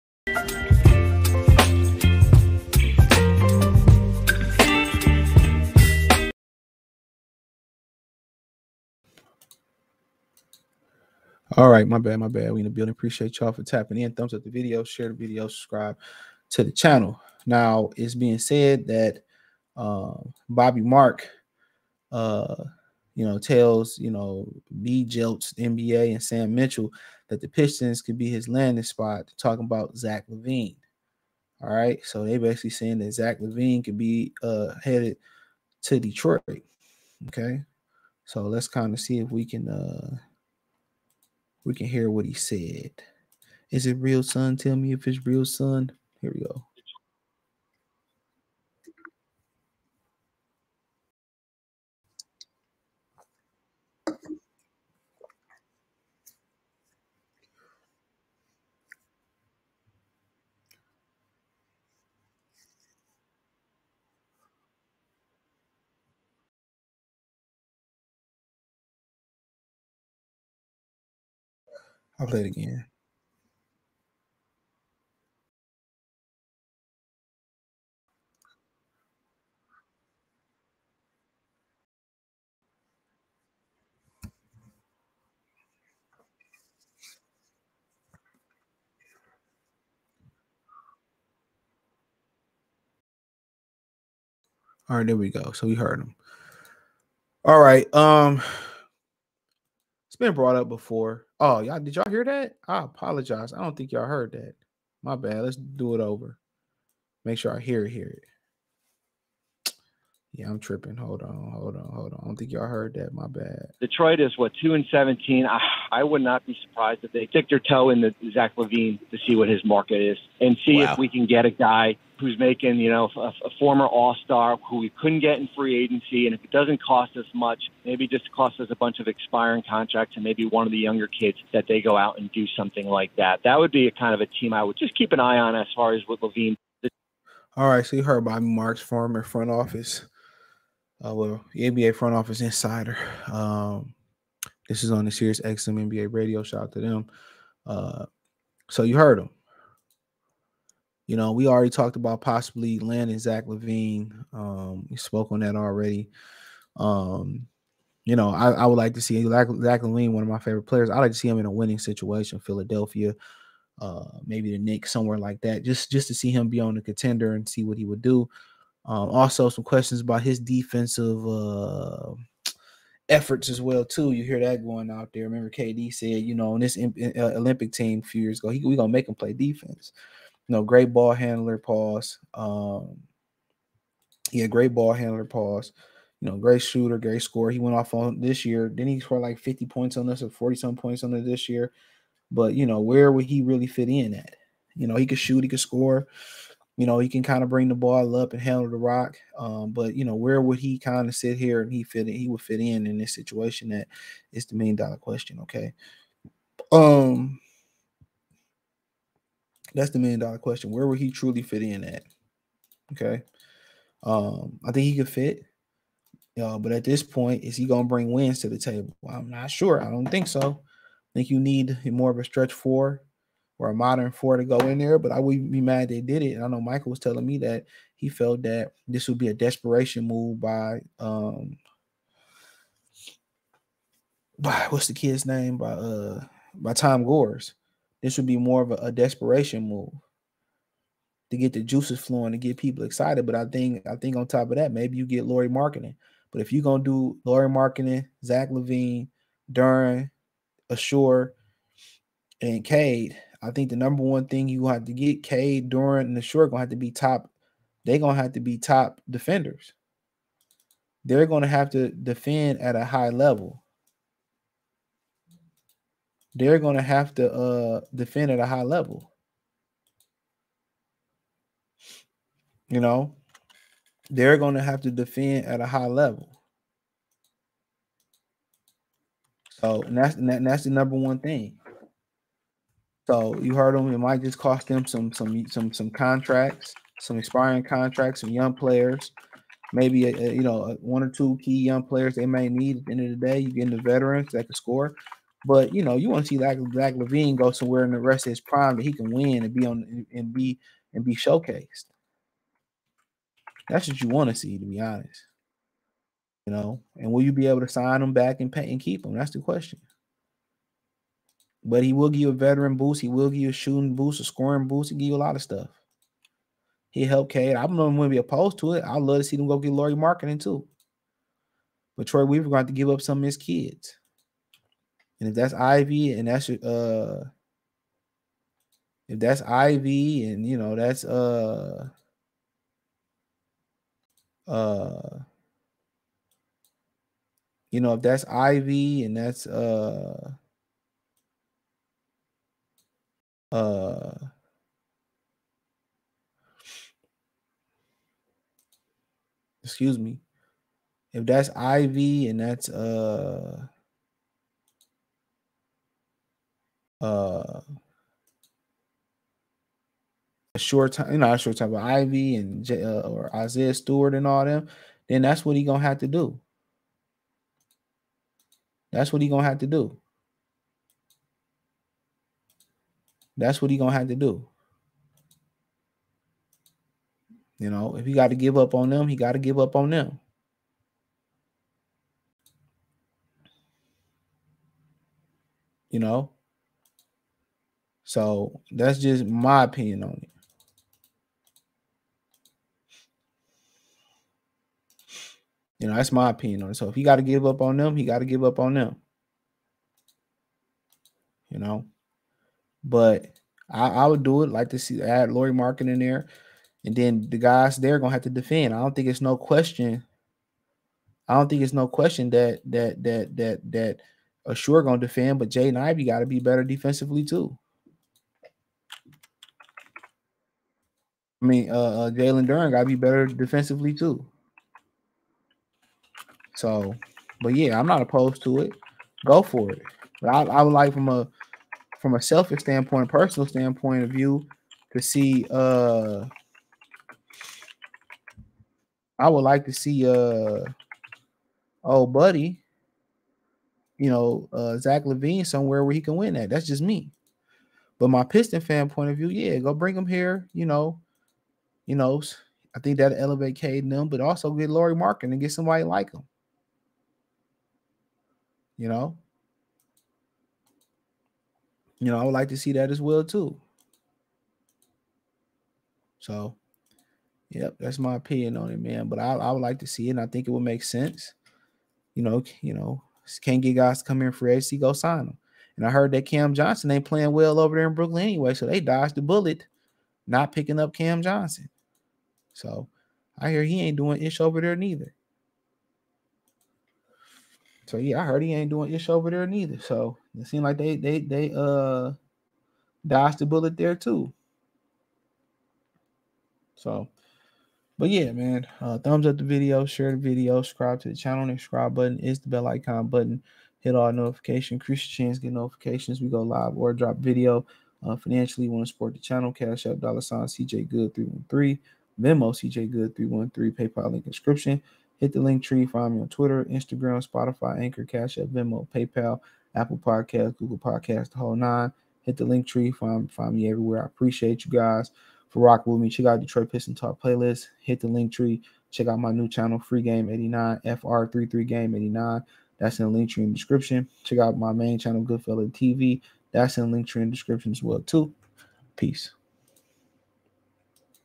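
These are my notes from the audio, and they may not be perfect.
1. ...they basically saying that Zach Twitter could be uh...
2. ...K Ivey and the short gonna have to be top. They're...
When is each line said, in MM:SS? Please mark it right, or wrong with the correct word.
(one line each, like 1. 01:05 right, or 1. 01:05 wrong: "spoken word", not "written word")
1. 00:32 wrong: "LaVine", not "Twitter"
2. 04:15 wrong: "Durant", not "Ivey".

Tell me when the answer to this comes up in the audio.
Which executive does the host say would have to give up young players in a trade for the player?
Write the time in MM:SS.
05:22.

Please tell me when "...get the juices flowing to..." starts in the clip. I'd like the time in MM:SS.
04:01.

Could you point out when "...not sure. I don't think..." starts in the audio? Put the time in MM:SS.
03:39.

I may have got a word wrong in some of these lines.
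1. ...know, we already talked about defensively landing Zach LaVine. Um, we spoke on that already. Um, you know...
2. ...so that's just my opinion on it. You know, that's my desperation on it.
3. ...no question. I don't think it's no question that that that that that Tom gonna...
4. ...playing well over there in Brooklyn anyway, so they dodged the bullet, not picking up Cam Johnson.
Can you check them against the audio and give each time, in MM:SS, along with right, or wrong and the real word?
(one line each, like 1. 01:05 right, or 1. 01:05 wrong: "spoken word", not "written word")
1. 02:31 wrong: "possibly", not "defensively"
2. 06:28 wrong: "opinion", not "desperation"
3. 06:49 wrong: "Ausar", not "Tom"
4. 07:57 right.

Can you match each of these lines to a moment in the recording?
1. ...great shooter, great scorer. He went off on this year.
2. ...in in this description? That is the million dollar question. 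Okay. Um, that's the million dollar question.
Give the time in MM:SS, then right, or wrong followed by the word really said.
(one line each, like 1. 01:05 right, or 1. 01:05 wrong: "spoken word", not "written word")
1. 03:06 right
2. 03:22 wrong: "situation", not "description".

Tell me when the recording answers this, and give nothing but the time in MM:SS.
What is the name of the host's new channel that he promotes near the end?
08:49.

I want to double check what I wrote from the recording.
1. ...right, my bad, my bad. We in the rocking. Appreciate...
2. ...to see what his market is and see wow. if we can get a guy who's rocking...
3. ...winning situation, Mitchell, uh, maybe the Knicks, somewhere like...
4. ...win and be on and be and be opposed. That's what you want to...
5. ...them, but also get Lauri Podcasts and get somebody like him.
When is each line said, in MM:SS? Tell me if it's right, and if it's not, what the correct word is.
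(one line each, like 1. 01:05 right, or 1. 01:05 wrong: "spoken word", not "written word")
1. 00:11 wrong: "building", not "rocking"
2. 01:59 wrong: "making", not "rocking"
3. 02:41 wrong: "Philadelphia", not "Mitchell"
4. 04:59 wrong: "showcased", not "opposed"
5. 07:33 wrong: "Markkanen", not "Podcasts".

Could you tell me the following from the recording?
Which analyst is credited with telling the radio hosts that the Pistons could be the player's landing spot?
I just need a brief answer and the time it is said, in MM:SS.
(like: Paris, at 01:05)
Bobby Marks, at 00:20.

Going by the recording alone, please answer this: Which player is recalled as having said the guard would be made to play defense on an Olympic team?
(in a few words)
KD.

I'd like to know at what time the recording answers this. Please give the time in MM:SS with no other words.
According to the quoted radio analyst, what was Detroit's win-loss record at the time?
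01:54.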